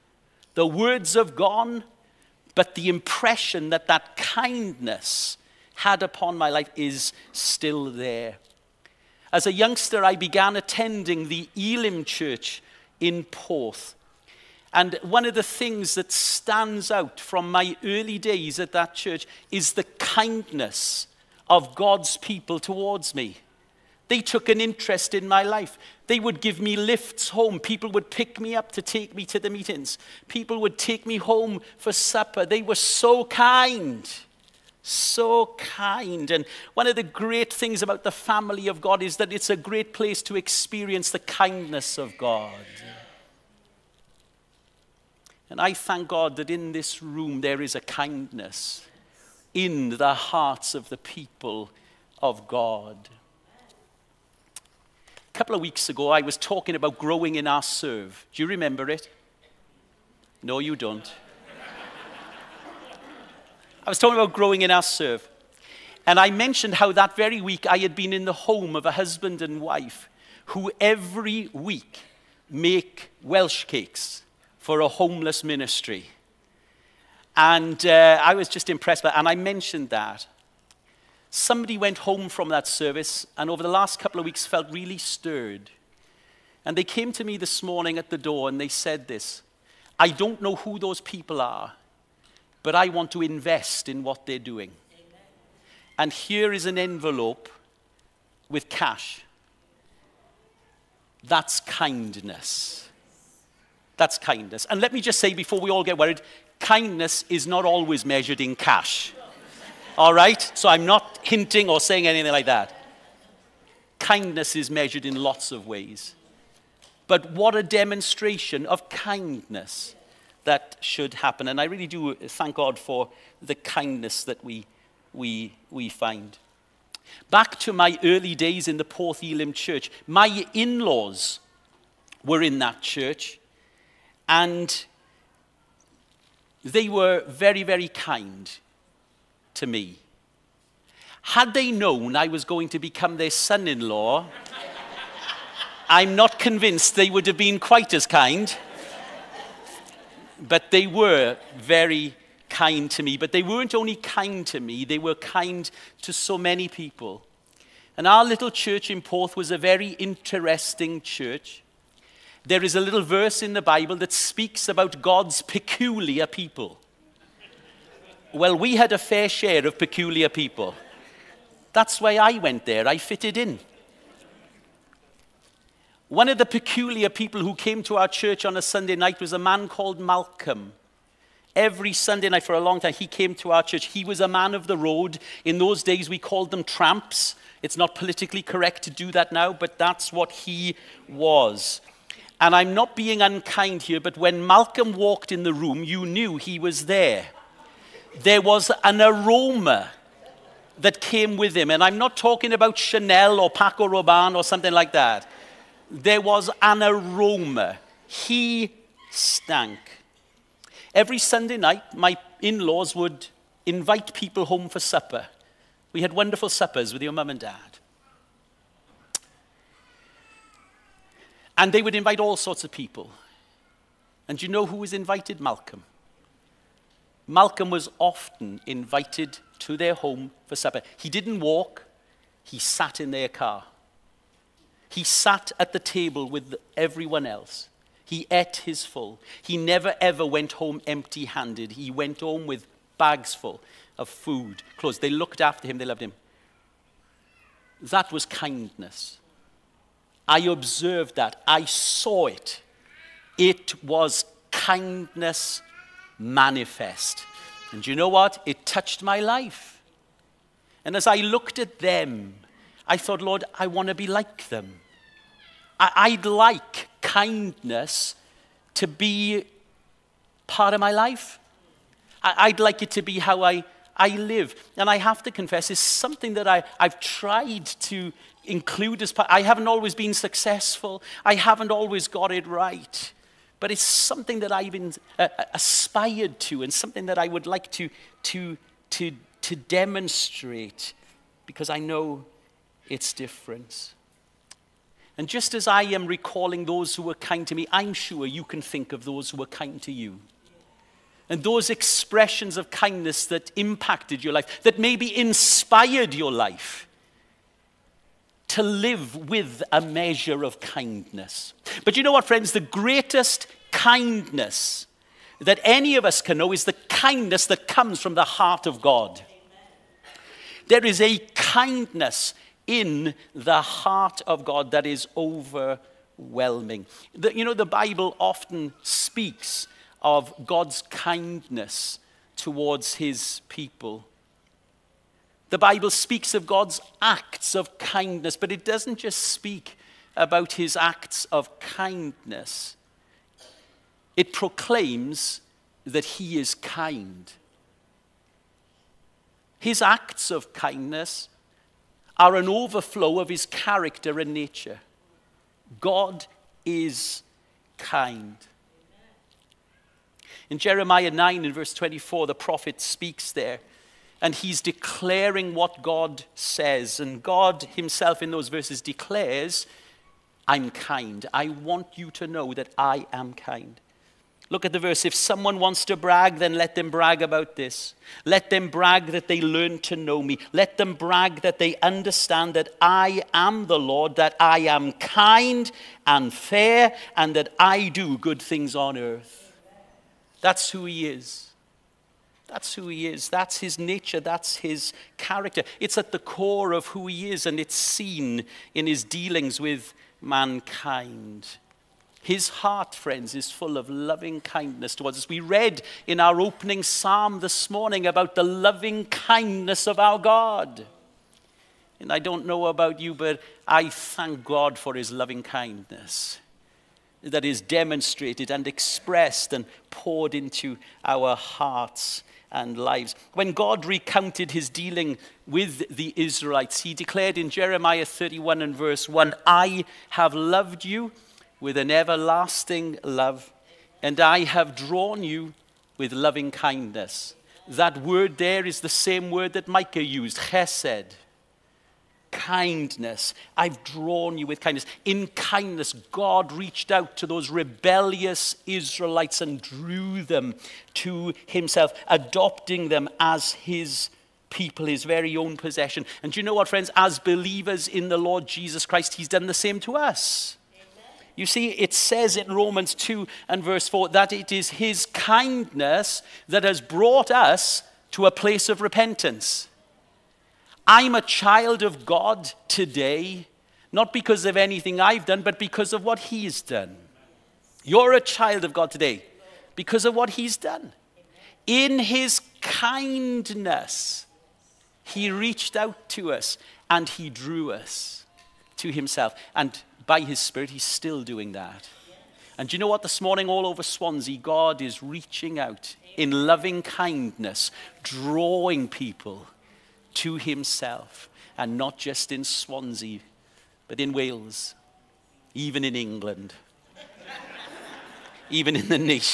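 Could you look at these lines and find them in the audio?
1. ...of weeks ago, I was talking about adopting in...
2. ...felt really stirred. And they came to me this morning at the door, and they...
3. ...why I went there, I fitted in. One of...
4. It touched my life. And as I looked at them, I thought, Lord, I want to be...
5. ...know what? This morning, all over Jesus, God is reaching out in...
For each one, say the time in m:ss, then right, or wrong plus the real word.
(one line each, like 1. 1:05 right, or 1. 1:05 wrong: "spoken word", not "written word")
1. 0:55 wrong: "growing", not "adopting"
2. 1:24 right
3. 2:51 right
4. 4:18 right
5. 8:12 wrong: "Swansea", not "Jesus".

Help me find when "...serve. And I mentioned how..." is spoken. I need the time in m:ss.
1:04.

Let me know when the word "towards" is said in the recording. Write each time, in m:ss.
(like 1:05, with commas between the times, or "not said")
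0:22, 5:32, 6:44.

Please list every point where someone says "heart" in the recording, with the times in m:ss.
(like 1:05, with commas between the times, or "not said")
0:50, 5:18, 5:23, 6:42, 7:01.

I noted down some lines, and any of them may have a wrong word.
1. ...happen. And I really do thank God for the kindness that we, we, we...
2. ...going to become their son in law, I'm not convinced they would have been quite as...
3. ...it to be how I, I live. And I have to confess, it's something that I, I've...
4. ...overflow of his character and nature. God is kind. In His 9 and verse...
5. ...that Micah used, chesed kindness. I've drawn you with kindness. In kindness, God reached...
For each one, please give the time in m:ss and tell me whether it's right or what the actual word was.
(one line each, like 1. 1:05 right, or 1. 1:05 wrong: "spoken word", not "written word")
1. 2:01 right
2. 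2:22 right
3. 4:32 right
4. 5:52 wrong: "Jeremiah", not "His"
5. 7:19 right.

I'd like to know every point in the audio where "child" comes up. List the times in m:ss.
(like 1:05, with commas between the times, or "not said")
7:51, 7:58.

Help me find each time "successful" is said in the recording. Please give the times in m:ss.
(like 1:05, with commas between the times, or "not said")
4:40.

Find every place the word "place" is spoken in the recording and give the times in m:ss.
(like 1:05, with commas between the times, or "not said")
0:39, 7:48.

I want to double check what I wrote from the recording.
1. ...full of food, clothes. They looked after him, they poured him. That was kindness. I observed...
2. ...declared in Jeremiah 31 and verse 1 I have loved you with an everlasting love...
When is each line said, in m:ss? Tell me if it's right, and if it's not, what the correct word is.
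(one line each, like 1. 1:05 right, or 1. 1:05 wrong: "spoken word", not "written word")
1. 4:03 wrong: "loved", not "poured"
2. 7:06 right.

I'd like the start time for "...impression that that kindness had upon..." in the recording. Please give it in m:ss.
0:02.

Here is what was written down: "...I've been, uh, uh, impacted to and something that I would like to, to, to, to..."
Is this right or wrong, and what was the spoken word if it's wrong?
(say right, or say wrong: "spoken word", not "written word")
wrong: "aspired", not "impacted".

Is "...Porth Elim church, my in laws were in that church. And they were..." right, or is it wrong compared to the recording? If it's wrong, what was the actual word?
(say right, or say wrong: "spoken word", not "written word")
right.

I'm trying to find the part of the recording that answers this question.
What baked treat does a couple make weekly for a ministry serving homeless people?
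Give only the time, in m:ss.
1:13.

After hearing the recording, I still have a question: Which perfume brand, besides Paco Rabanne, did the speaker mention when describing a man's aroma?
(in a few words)
Chanel.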